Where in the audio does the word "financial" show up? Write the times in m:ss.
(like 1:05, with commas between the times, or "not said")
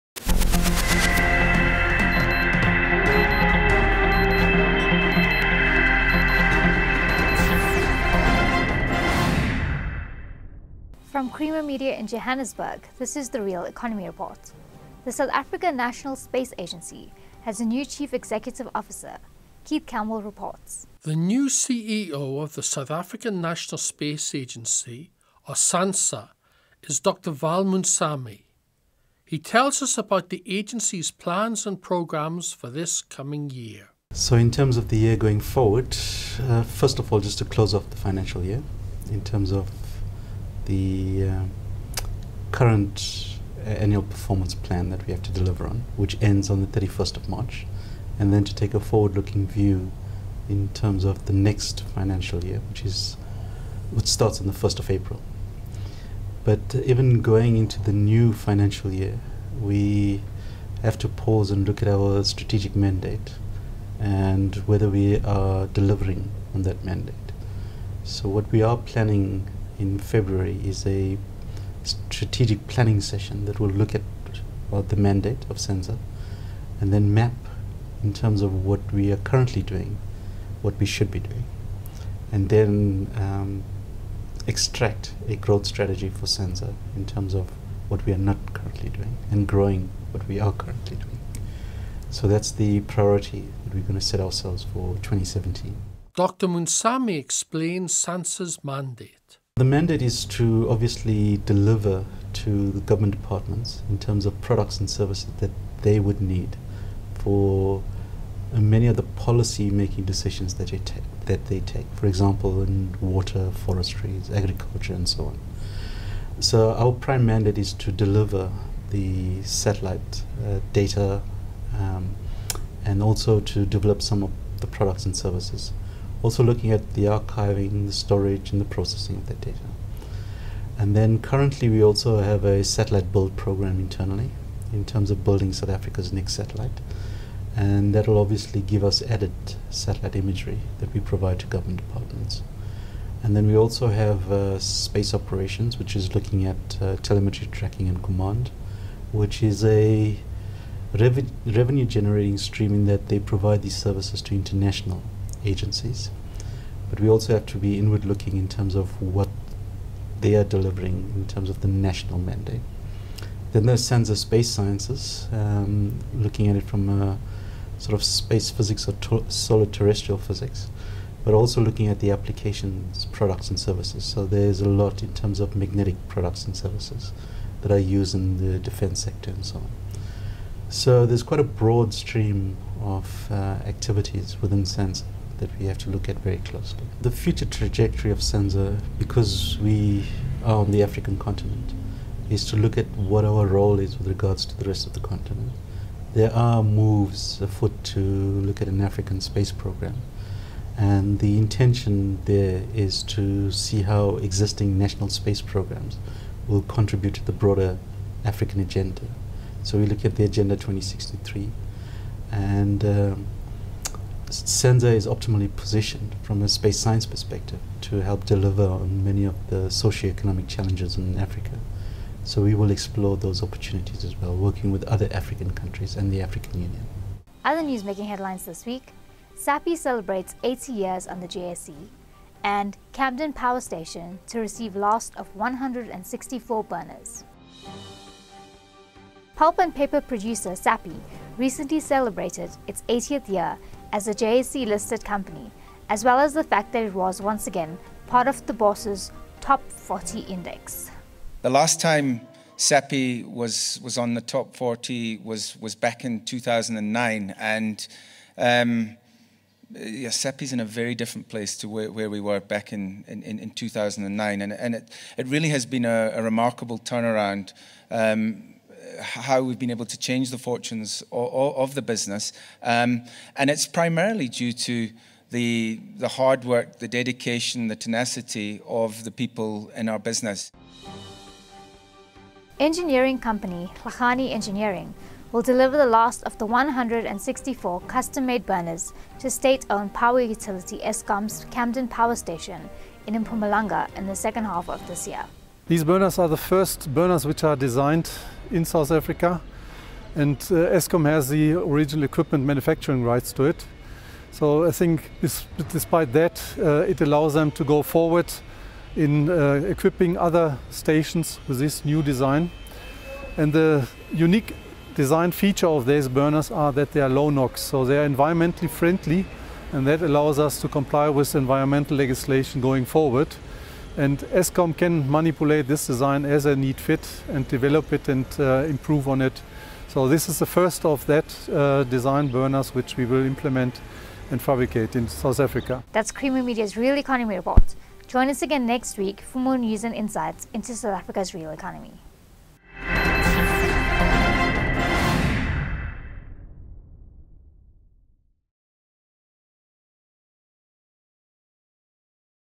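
0:37, 0:51, 0:58.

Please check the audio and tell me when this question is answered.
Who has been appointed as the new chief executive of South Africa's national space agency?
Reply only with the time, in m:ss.
0:27.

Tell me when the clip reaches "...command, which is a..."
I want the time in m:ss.
2:28.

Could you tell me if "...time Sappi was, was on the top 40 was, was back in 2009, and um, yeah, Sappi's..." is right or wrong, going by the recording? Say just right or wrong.
right.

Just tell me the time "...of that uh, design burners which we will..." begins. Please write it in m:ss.
5:30.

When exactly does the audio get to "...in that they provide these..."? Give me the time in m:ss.
2:32.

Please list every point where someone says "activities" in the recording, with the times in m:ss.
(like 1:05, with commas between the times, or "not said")
3:03.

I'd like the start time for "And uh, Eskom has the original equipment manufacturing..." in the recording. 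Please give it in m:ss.
5:00.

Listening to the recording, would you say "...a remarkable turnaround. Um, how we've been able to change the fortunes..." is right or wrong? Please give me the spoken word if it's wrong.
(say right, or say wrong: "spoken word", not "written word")
right.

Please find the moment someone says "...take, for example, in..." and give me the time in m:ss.
1:51.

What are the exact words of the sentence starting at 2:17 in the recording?
And that will obviously give us added satellite imagery that we provide to government departments.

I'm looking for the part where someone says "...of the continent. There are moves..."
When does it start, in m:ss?
3:14.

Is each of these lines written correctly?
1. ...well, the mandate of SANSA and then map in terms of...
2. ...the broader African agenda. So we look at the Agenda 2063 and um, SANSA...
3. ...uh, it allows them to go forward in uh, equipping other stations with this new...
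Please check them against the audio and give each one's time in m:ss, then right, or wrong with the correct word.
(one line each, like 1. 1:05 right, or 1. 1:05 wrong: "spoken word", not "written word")
1. 1:14 right
2. 3:27 right
3. 5:06 right.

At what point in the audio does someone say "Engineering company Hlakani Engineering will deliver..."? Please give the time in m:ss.
4:42.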